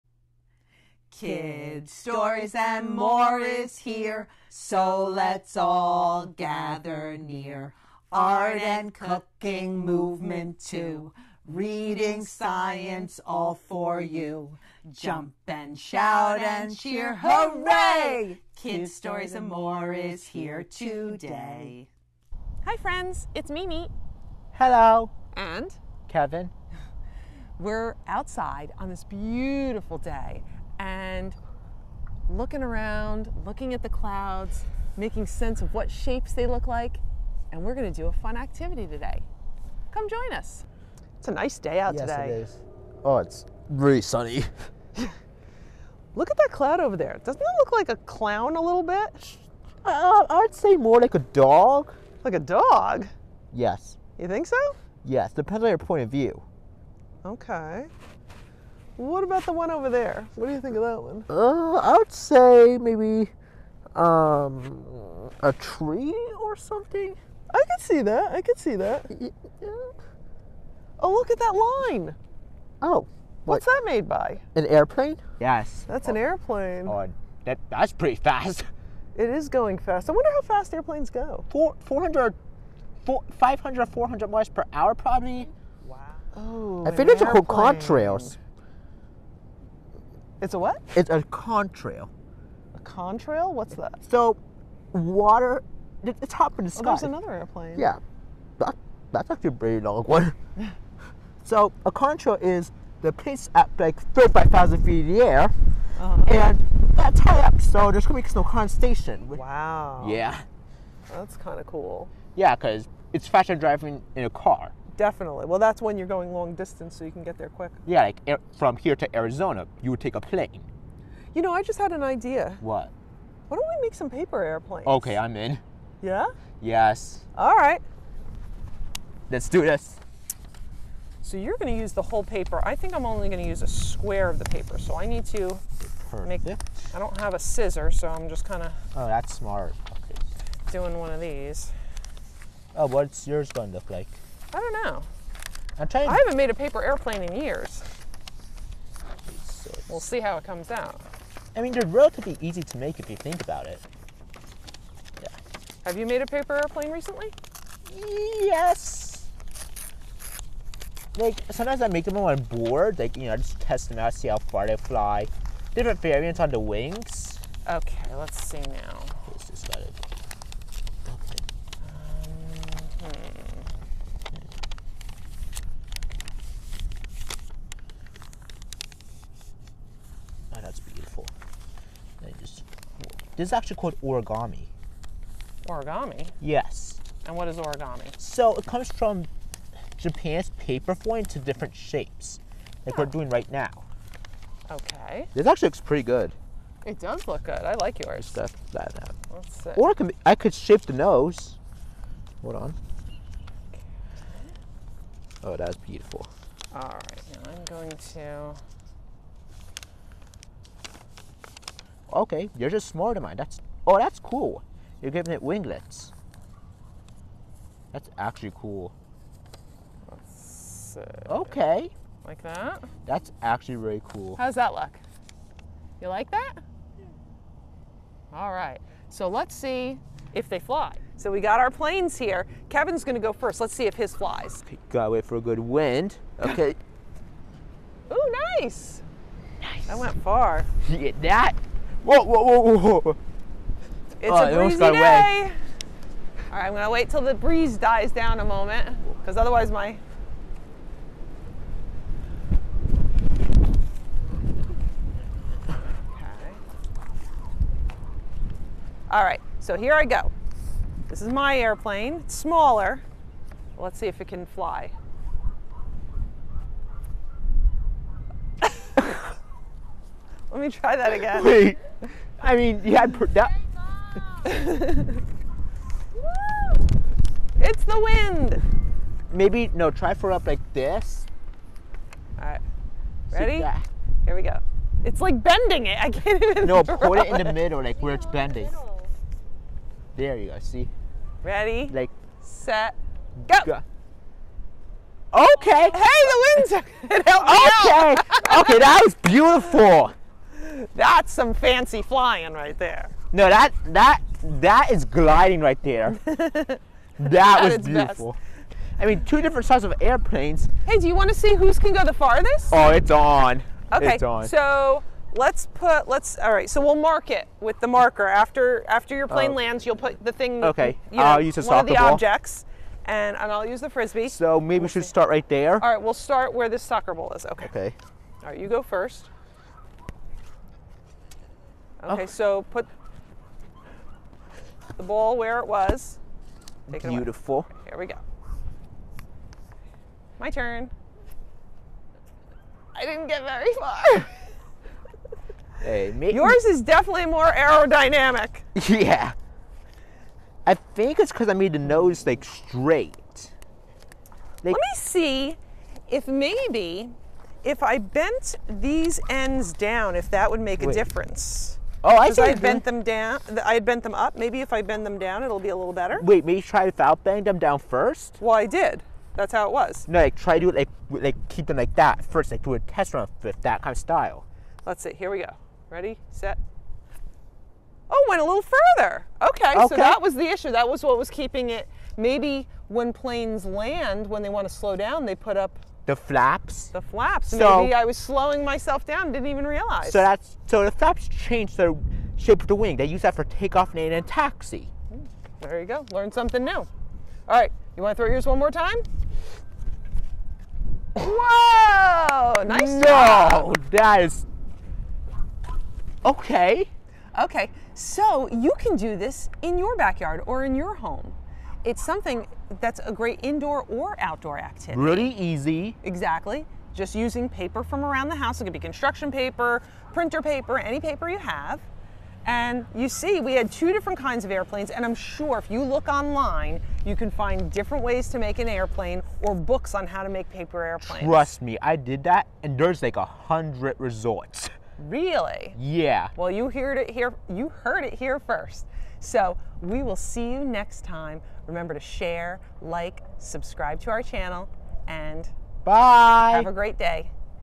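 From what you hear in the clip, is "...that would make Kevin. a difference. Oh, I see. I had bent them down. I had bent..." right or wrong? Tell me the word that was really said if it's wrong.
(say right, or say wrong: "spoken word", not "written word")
wrong: "Wait", not "Kevin".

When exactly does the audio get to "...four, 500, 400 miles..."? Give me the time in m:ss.
1:23.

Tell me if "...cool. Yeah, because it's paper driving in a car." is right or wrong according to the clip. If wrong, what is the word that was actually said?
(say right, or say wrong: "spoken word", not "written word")
wrong: "faster", not "paper".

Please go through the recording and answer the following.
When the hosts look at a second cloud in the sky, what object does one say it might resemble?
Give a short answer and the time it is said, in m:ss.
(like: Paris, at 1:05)
tree, at 1:05.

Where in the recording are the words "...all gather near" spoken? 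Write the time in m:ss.
0:05.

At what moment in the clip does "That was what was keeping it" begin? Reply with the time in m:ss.
6:20.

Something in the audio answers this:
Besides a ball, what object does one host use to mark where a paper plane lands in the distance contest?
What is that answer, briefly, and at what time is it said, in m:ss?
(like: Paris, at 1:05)
frisbee, at 5:23.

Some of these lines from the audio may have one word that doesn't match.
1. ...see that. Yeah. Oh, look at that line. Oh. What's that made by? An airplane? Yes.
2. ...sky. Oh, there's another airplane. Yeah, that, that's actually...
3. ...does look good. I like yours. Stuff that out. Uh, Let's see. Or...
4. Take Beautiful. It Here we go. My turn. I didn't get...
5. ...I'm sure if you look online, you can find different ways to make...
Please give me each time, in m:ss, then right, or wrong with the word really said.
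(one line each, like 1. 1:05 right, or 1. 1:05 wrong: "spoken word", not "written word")
1. 1:08 right
2. 1:36 right
3. 3:16 right
4. 5:36 right
5. 7:05 right.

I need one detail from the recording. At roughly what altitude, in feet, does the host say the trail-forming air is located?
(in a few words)
35,000 feet.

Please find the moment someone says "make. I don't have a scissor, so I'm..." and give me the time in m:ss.
2:16.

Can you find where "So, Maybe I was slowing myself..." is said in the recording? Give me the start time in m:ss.
6:27.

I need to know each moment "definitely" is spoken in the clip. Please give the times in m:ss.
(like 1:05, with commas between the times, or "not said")
1:54, 5:46.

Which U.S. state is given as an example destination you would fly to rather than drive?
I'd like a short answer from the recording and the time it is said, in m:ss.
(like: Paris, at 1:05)
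Arizona, at 1:59.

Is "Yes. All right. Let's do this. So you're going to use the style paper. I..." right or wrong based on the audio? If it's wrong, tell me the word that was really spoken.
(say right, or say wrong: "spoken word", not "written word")
wrong: "whole", not "style".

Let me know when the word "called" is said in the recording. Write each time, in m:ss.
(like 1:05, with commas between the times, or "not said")
1:27, 3:03.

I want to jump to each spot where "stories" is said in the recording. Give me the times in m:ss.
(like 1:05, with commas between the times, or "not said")
0:01, 0:18.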